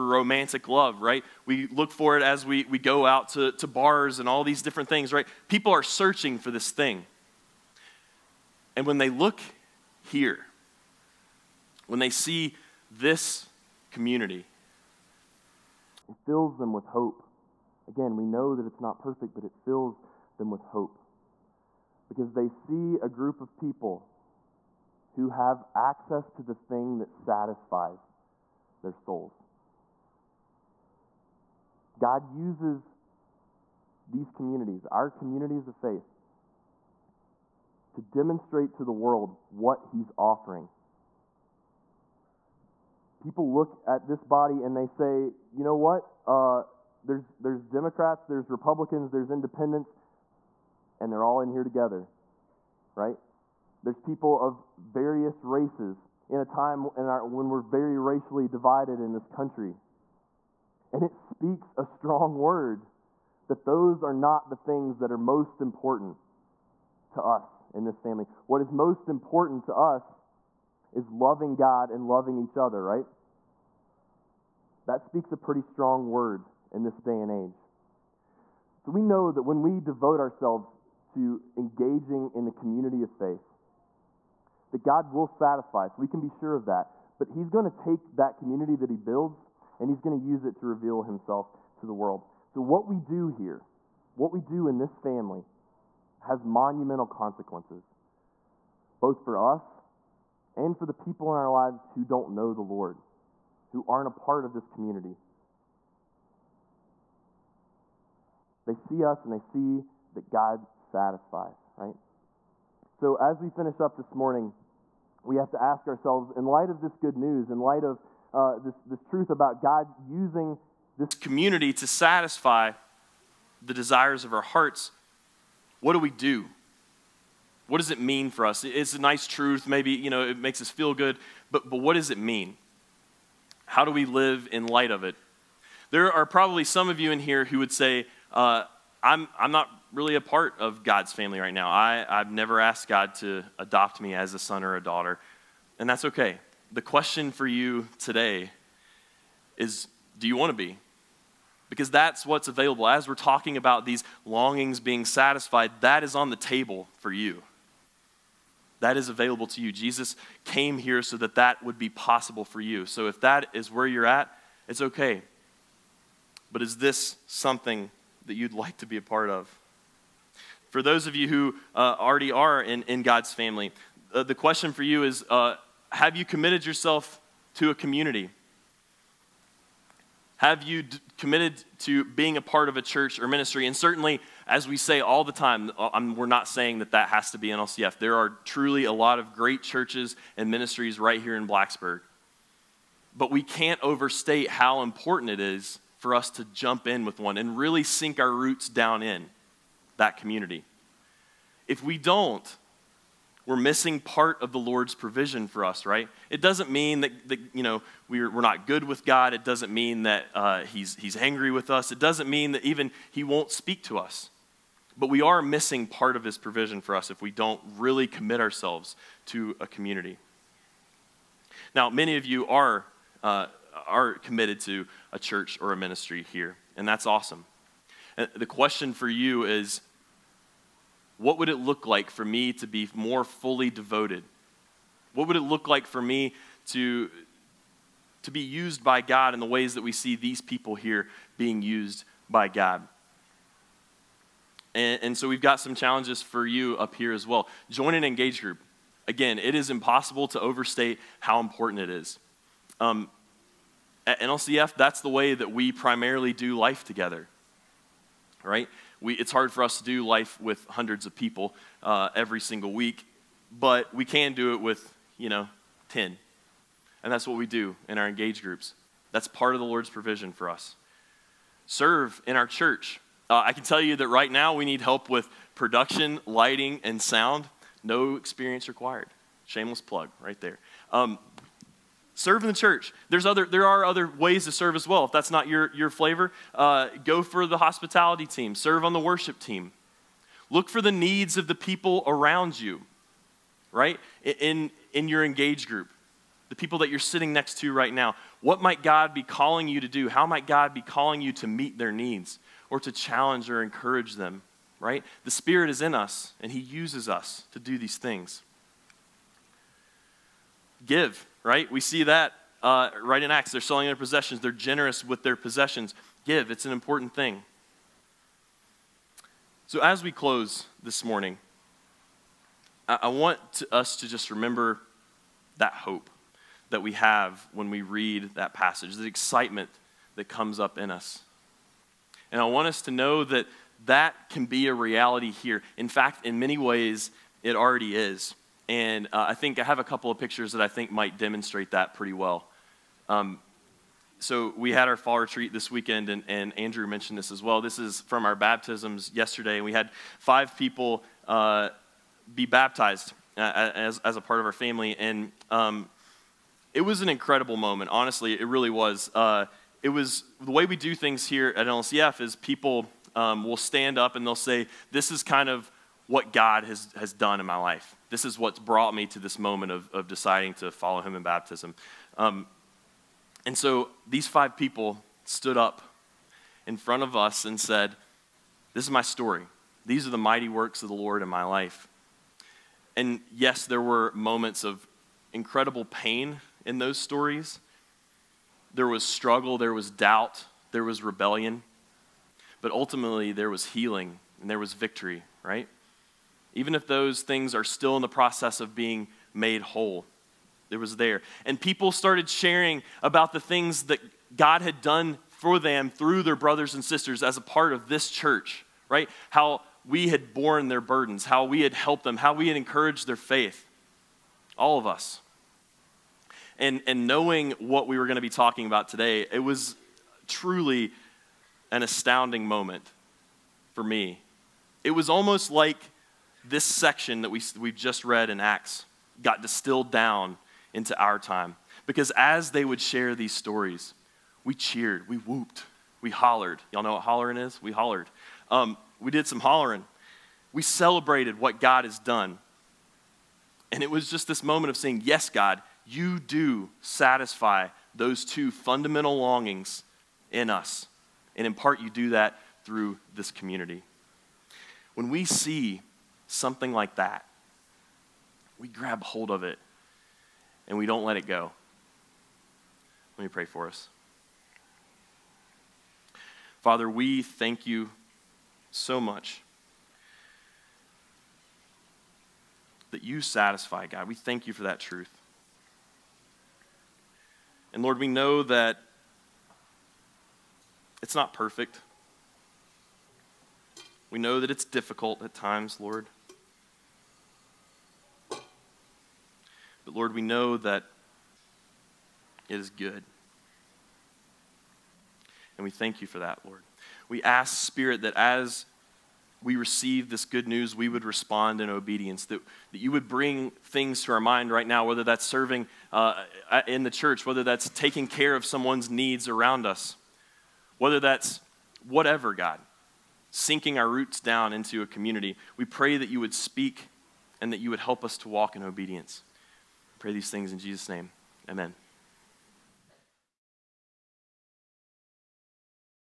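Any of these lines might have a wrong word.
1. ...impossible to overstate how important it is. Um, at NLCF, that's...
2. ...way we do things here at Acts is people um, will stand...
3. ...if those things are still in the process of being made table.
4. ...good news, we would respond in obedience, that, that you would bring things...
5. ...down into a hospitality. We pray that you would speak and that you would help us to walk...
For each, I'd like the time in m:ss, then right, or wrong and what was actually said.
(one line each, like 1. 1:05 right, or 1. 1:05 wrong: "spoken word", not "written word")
1. 4:09 right
2. 6:00 wrong: "NLCF", not "Acts"
3. 6:36 wrong: "whole", not "table"
4. 8:20 right
5. 8:34 wrong: "community", not "hospitality".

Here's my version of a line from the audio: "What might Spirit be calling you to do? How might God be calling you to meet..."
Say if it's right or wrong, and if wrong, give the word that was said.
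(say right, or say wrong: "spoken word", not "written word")
wrong: "God", not "Spirit".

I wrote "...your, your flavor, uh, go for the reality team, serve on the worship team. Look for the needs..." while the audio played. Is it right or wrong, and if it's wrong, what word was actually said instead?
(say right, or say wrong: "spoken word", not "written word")
wrong: "hospitality", not "reality".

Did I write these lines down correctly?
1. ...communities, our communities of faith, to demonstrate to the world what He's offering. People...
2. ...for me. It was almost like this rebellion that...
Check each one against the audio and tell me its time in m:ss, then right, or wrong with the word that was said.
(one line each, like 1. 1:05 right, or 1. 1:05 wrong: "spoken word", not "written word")
1. 0:34 right
2. 7:03 wrong: "section", not "rebellion".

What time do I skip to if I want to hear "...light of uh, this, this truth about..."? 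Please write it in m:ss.
1:57.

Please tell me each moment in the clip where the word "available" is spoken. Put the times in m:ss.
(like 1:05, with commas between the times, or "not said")
2:32, 2:39.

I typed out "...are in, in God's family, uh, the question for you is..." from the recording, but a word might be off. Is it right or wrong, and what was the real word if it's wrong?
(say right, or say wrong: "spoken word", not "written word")
right.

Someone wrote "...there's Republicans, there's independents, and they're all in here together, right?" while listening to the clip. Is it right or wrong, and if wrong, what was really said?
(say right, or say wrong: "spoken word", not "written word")
right.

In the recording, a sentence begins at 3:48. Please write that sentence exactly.
And the question for you is what would it look like for me to be more fully devoted?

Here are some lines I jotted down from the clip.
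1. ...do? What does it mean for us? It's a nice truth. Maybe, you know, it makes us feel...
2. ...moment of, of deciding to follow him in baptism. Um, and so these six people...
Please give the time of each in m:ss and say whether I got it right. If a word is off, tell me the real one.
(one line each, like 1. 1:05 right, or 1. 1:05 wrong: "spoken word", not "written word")
1. 2:06 right
2. 6:09 wrong: "five", not "six".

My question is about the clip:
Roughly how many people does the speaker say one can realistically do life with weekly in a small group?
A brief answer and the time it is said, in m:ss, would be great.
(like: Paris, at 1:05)
10, at 4:25.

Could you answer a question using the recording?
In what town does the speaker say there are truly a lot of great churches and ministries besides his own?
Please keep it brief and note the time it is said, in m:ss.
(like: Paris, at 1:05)
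Blacksburg, at 3:11.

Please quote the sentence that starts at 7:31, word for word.
And in part, you do that through this community.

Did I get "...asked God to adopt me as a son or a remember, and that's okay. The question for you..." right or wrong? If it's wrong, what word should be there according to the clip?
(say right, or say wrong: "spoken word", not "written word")
wrong: "daughter", not "remember".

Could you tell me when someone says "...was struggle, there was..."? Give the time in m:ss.
6:28.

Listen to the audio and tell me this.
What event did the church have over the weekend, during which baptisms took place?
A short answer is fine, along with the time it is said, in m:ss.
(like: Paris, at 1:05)
fall retreat, at 5:44.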